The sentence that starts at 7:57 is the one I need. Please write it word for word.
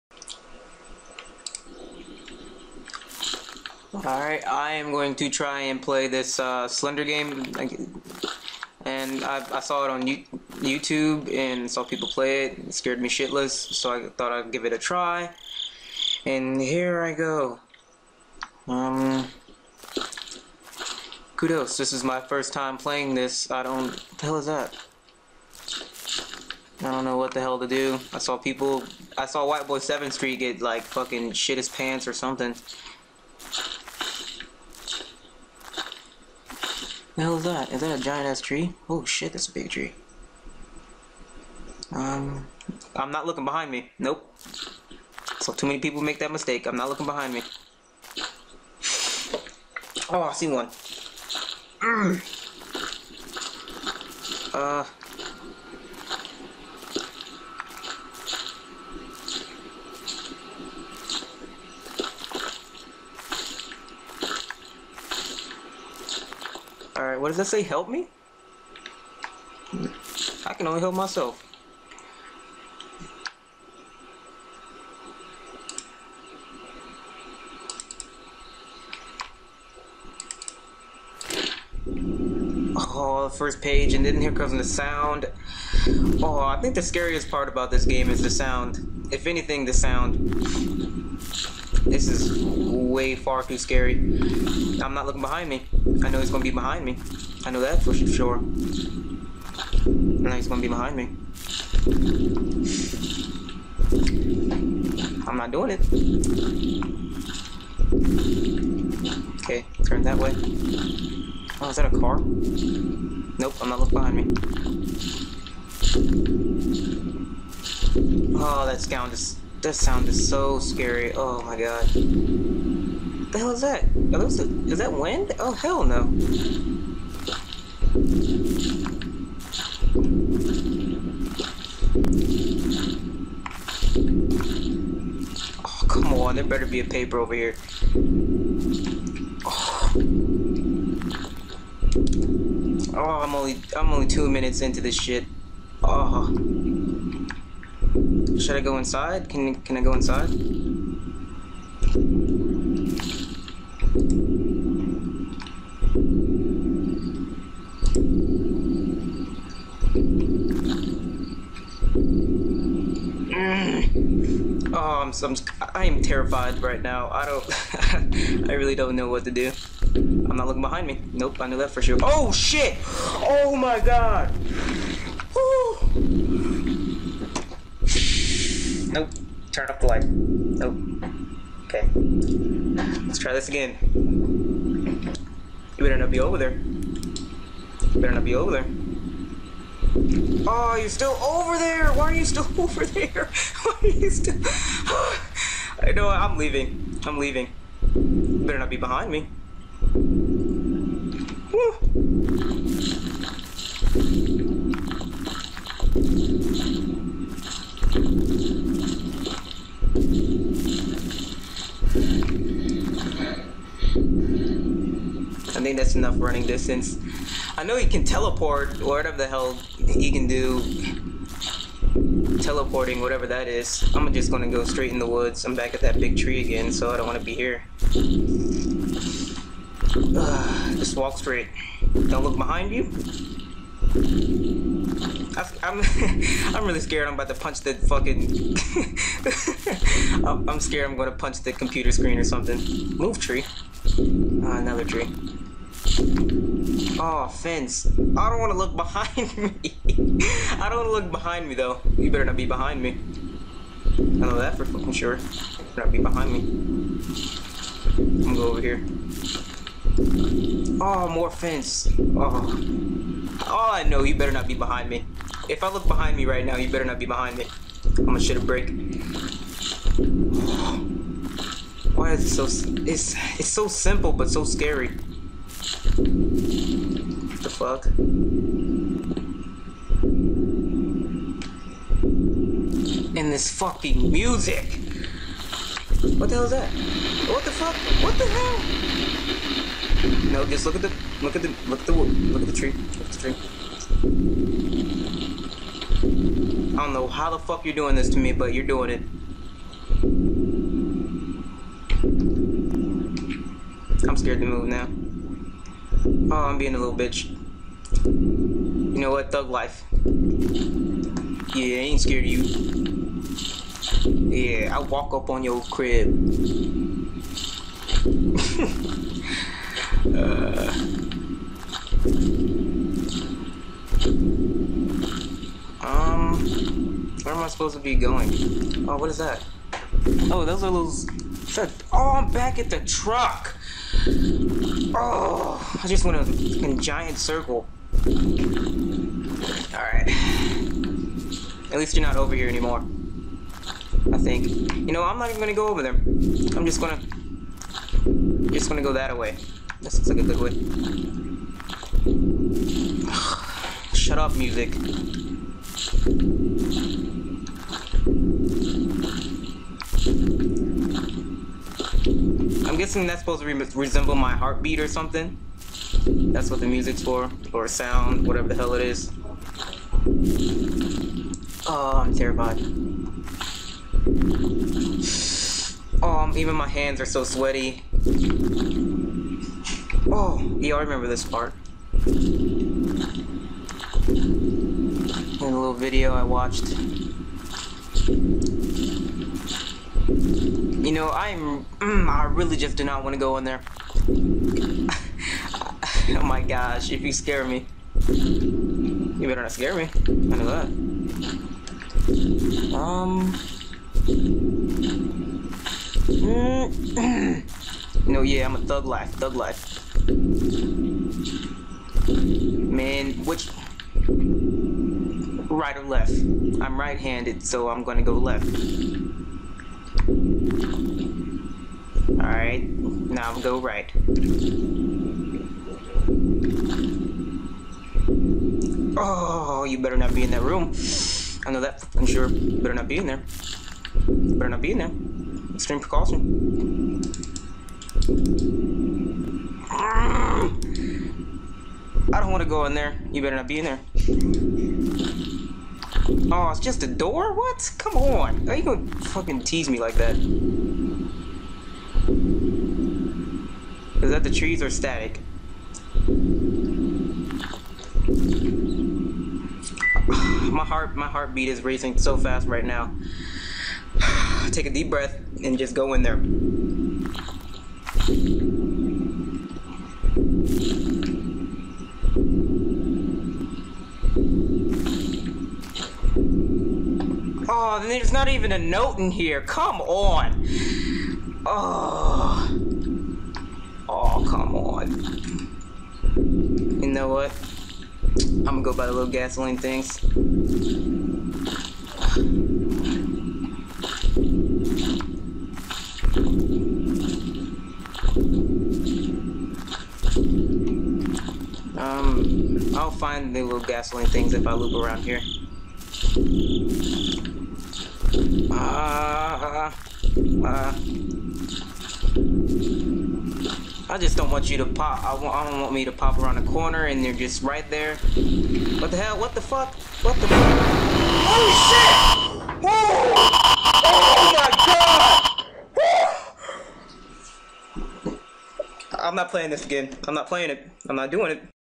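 and there's not even a note in here.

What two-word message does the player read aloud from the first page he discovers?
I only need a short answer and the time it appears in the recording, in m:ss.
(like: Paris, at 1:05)
Help me, at 1:07.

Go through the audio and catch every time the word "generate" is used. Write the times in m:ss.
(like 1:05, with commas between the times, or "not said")
not said.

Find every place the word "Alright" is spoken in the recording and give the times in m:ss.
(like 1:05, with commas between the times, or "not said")
0:03, 1:06, 5:38, 7:02.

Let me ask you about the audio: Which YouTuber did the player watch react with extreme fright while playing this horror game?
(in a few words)
White Boy 7th Street.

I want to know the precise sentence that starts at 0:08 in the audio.
And I, I saw it on YouTube and saw people play it.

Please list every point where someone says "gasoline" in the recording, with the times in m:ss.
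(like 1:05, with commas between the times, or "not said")
8:09, 8:23.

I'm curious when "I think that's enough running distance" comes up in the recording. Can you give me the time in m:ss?
3:35.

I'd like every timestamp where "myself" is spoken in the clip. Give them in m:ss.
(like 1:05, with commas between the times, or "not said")
1:10.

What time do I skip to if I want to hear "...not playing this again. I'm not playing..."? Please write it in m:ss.
8:49.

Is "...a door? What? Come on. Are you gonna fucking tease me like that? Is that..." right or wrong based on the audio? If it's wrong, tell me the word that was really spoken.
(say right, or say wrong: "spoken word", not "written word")
right.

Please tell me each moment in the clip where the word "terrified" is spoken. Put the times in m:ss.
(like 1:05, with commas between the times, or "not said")
2:46, 6:12.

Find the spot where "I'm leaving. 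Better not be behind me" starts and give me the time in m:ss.
3:17.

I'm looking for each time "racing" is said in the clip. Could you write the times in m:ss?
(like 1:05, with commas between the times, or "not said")
7:41.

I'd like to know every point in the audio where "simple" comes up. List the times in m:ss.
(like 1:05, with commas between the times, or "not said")
4:33.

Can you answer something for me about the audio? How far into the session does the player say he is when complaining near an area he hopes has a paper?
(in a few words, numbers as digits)
2 minutes.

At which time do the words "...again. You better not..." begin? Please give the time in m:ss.
3:03.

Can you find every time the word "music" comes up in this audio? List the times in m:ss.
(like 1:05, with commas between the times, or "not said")
4:44, 5:54, 6:06.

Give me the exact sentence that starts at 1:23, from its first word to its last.
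Oh, first page, and then here comes the sound.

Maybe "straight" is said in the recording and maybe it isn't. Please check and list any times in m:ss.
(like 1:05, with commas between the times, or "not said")
3:44, 3:51.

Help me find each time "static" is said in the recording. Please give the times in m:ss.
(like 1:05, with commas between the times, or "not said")
7:34.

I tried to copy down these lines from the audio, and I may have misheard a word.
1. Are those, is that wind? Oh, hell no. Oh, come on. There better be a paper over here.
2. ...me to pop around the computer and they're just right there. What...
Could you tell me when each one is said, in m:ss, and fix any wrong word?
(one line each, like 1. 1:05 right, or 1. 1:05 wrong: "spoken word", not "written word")
1. 2:03 right
2. 8:35 wrong: "corner", not "computer".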